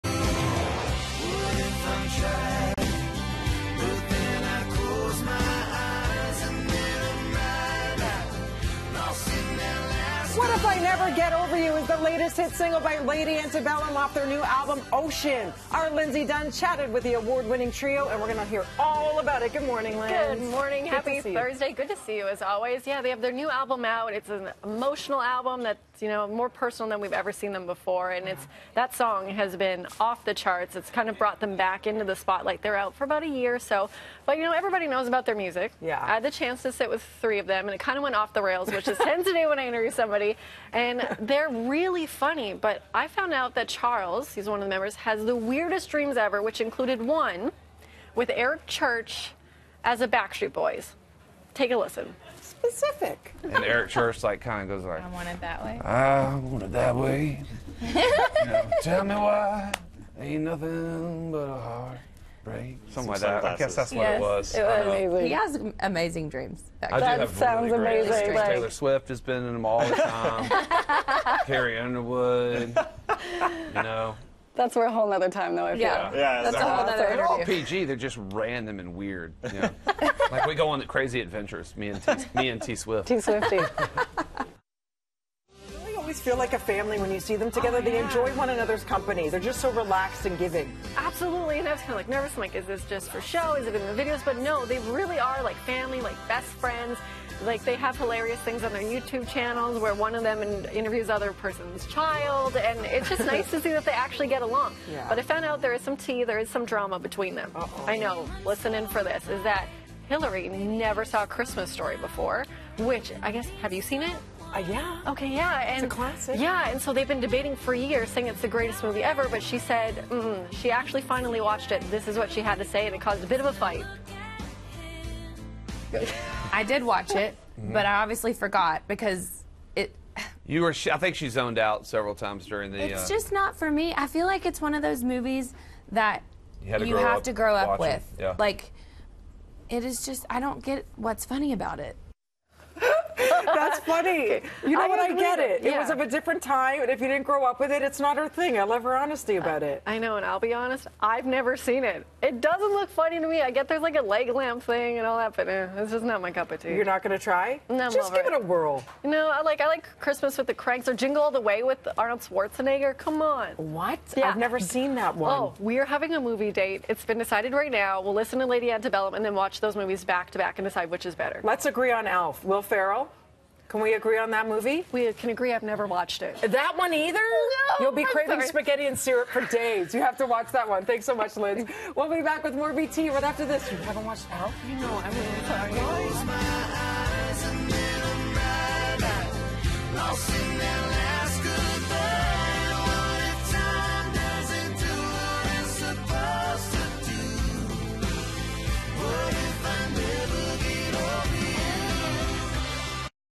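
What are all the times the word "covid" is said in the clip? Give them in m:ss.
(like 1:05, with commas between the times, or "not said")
not said.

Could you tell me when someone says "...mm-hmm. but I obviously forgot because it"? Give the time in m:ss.
2:07.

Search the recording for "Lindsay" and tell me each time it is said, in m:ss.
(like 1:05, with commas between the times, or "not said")
0:15, 0:19.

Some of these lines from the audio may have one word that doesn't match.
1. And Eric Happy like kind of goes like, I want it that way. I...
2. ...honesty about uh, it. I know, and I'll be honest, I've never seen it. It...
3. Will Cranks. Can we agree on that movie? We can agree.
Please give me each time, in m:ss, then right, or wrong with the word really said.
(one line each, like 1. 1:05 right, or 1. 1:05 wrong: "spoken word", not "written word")
1. 0:53 wrong: "Church", not "Happy"
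2. 2:28 right
3. 2:52 wrong: "Ferrell", not "Cranks".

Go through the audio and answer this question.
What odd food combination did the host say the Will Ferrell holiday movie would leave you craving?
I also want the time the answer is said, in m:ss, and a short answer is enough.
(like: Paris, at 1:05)
spaghetti and syrup, at 2:58.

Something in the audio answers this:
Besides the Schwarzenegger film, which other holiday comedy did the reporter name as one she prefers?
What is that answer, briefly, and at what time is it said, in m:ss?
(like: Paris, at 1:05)
Christmas with the Cranks, at 2:39.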